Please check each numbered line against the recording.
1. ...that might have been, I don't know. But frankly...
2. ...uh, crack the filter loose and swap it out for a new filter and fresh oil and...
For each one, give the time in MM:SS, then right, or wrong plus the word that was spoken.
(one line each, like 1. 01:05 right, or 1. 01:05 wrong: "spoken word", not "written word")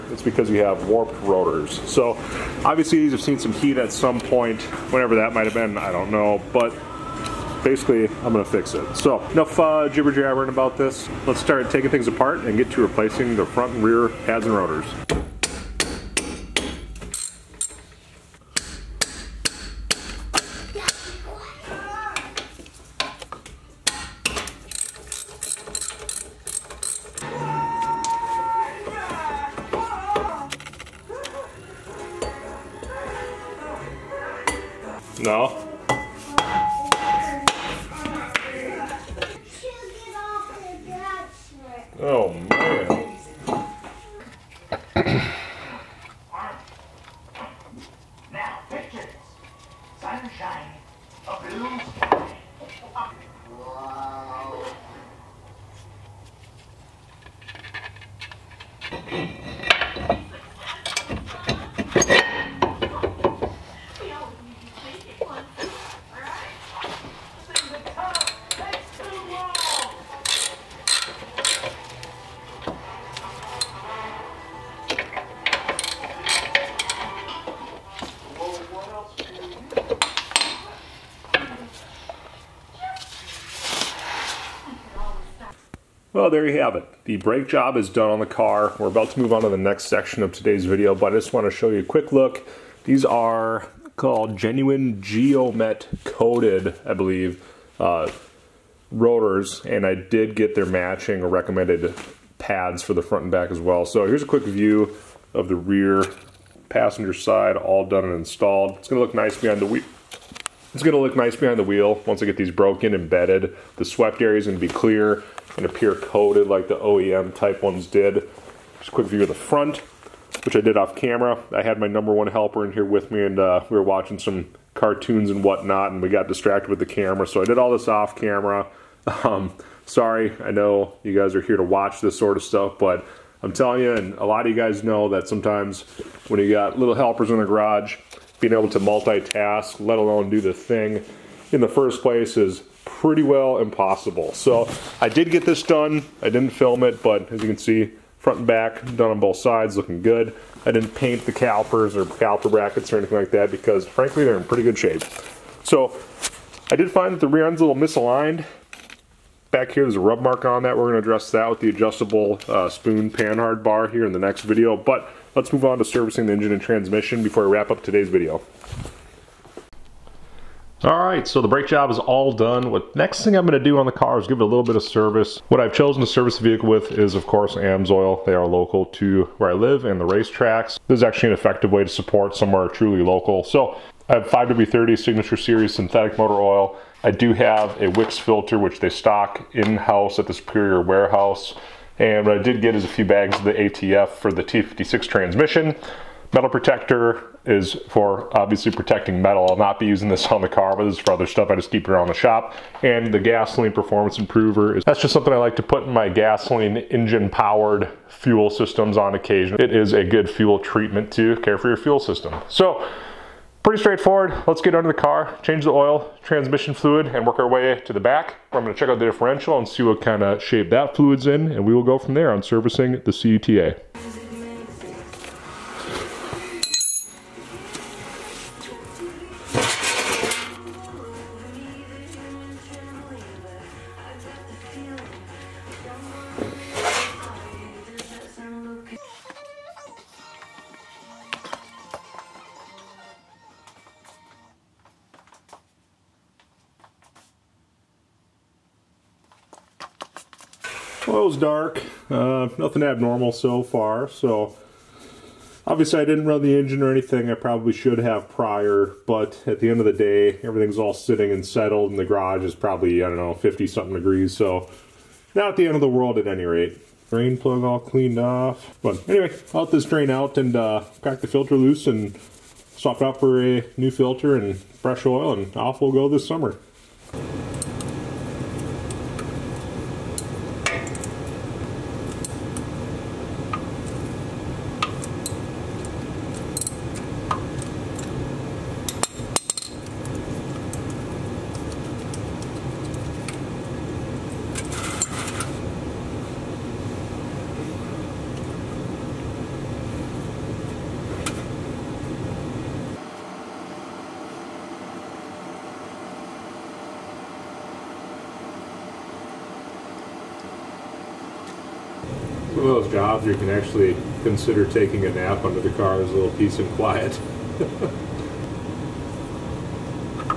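1. 00:05 wrong: "basically", not "frankly"
2. 04:30 right.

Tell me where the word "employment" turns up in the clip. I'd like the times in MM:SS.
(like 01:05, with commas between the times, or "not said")
not said.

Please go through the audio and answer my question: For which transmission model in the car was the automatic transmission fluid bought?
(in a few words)
T56.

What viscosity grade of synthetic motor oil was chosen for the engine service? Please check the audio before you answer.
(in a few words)
5W30.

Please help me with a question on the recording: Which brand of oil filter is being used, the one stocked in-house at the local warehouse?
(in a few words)
Wix.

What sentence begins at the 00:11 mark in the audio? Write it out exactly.
Let's start taking things apart and get to replacing the front and rear pads and rotors.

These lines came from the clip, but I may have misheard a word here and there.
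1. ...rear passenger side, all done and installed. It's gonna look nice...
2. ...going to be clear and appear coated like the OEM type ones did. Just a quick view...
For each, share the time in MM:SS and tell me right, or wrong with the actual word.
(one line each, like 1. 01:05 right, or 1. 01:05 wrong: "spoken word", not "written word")
1. 01:45 right
2. 01:54 right.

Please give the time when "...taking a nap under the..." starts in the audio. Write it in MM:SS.
05:14.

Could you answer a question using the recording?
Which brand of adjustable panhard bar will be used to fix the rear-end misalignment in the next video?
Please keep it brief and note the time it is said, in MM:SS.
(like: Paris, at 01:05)
Spohn, at 02:42.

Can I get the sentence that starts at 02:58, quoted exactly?
They are local to where I live and the racetracks.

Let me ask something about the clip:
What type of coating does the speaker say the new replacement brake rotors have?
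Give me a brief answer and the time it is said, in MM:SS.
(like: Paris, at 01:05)
Geomet, at 01:35.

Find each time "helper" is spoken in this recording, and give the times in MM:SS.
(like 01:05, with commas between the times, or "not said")
02:02, 02:16.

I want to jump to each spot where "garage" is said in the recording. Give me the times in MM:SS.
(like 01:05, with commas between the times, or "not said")
02:17, 04:22.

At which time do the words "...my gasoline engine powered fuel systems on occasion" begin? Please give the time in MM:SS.
03:25.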